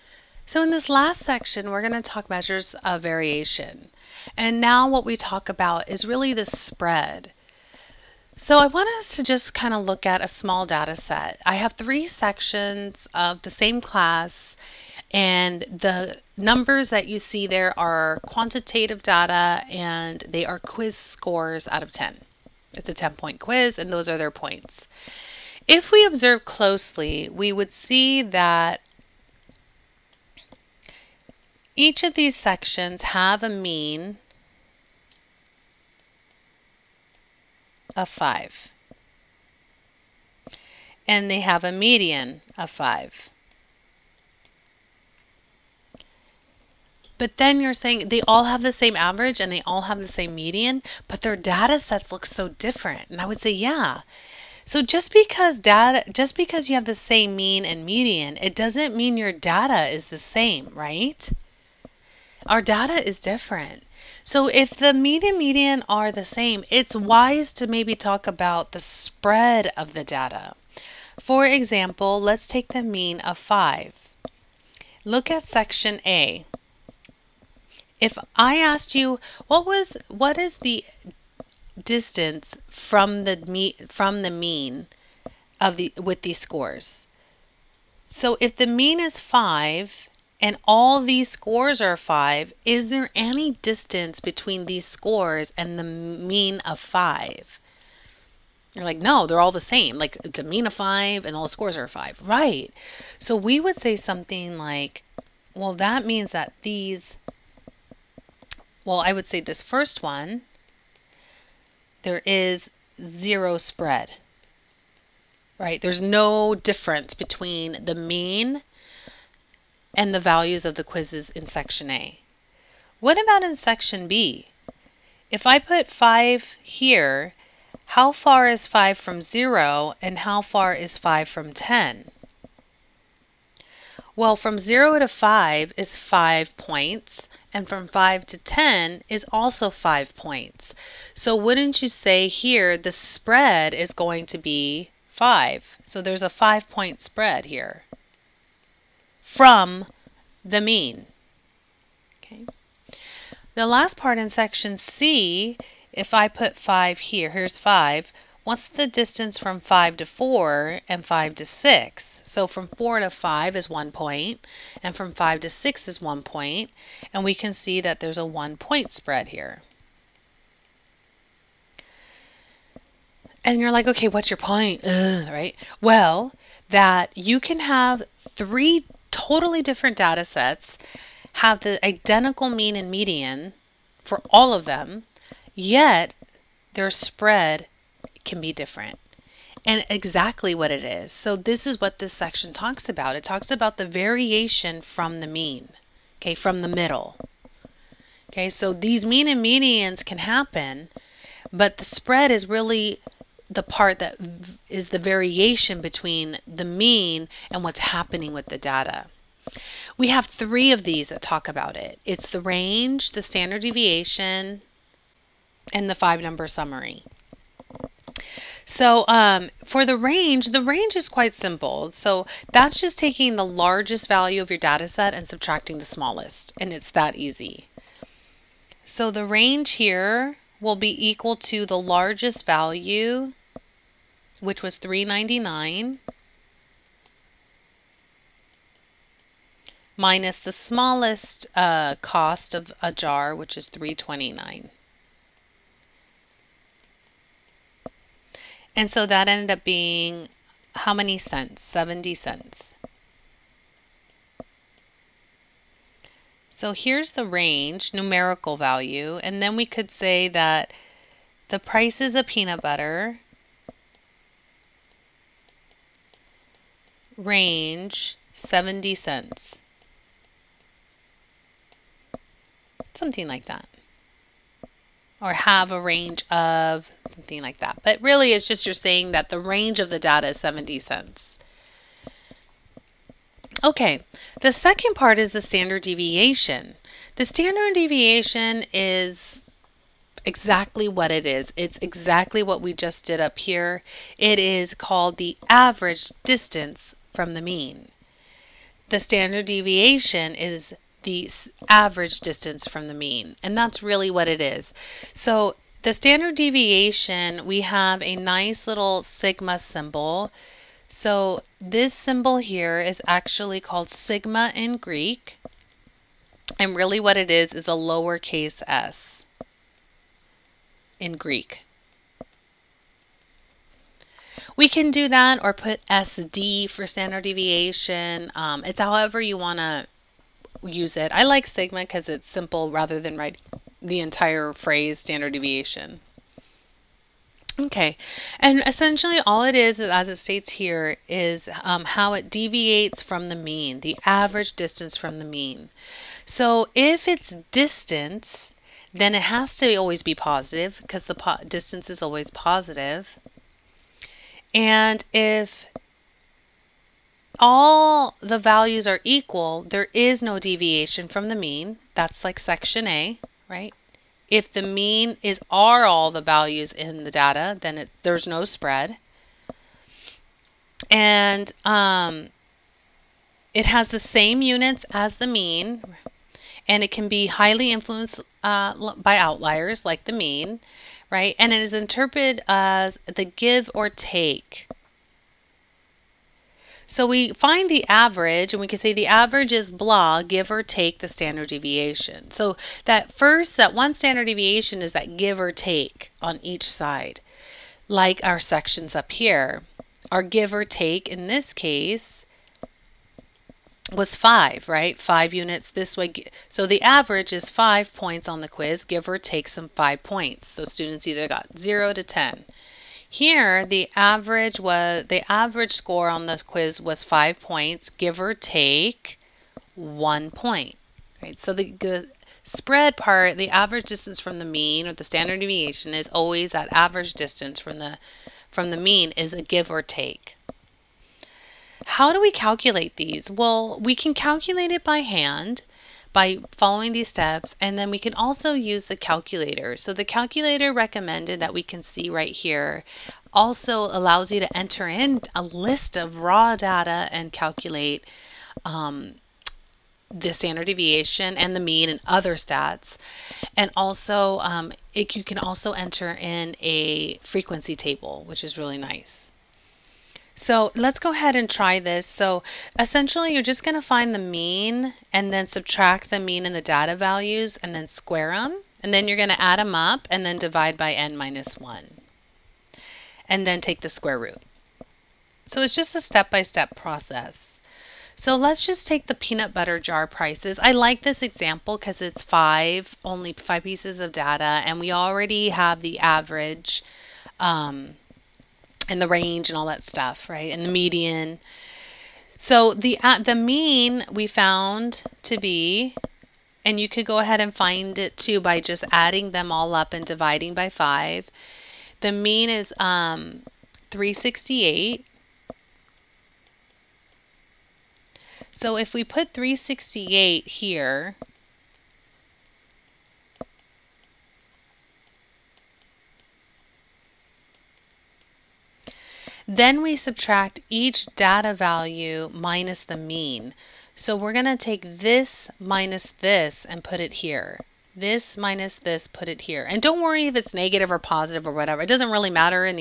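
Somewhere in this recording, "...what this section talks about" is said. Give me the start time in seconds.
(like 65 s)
191 s.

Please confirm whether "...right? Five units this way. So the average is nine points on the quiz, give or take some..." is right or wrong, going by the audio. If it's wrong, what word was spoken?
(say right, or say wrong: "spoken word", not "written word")
wrong: "five", not "nine".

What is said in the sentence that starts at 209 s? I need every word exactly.
We have three of these that talk about it.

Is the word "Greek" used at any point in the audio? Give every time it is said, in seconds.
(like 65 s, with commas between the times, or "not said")
314 s, 321 s.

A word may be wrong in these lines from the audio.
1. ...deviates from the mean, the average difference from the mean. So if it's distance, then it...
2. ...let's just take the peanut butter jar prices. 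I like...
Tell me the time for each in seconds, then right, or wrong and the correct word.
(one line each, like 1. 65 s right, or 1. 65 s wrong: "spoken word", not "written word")
1. 342 s wrong: "distance", not "difference"
2. 478 s right.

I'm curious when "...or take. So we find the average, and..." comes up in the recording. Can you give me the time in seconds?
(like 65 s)
383 s.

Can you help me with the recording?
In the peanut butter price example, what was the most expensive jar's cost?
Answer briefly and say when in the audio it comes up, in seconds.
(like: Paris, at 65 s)
$3.99, at 234 s.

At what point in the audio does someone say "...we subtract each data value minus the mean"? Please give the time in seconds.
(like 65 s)
519 s.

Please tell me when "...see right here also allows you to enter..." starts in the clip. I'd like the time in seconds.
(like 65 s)
441 s.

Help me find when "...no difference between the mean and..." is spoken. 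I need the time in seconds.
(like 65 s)
116 s.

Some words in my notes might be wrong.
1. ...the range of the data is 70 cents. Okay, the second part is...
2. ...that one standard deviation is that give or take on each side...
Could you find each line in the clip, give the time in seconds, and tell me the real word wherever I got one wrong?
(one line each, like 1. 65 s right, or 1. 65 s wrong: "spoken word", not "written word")
1. 279 s right
2. 393 s right.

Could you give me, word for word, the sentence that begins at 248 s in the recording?
And so that ended up being how many cents?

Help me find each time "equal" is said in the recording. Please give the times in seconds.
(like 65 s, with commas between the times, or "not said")
231 s, 359 s.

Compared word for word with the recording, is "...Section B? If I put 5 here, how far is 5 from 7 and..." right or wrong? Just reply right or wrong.
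wrong.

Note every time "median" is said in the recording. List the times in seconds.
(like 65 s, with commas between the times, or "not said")
41 s, 50 s, 57 s, 65 s, 182 s, 199 s, 490 s.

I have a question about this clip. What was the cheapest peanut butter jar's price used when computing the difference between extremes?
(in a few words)
$3.29.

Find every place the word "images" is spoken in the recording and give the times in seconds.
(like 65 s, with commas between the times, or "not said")
not said.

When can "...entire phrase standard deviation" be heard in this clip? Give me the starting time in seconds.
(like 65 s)
333 s.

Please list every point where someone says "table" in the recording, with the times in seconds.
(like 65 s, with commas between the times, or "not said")
457 s.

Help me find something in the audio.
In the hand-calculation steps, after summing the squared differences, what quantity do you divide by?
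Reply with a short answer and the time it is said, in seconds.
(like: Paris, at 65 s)
n minus 1, at 470 s.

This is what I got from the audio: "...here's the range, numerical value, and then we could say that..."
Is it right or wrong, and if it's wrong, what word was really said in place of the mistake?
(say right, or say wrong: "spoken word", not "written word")
right.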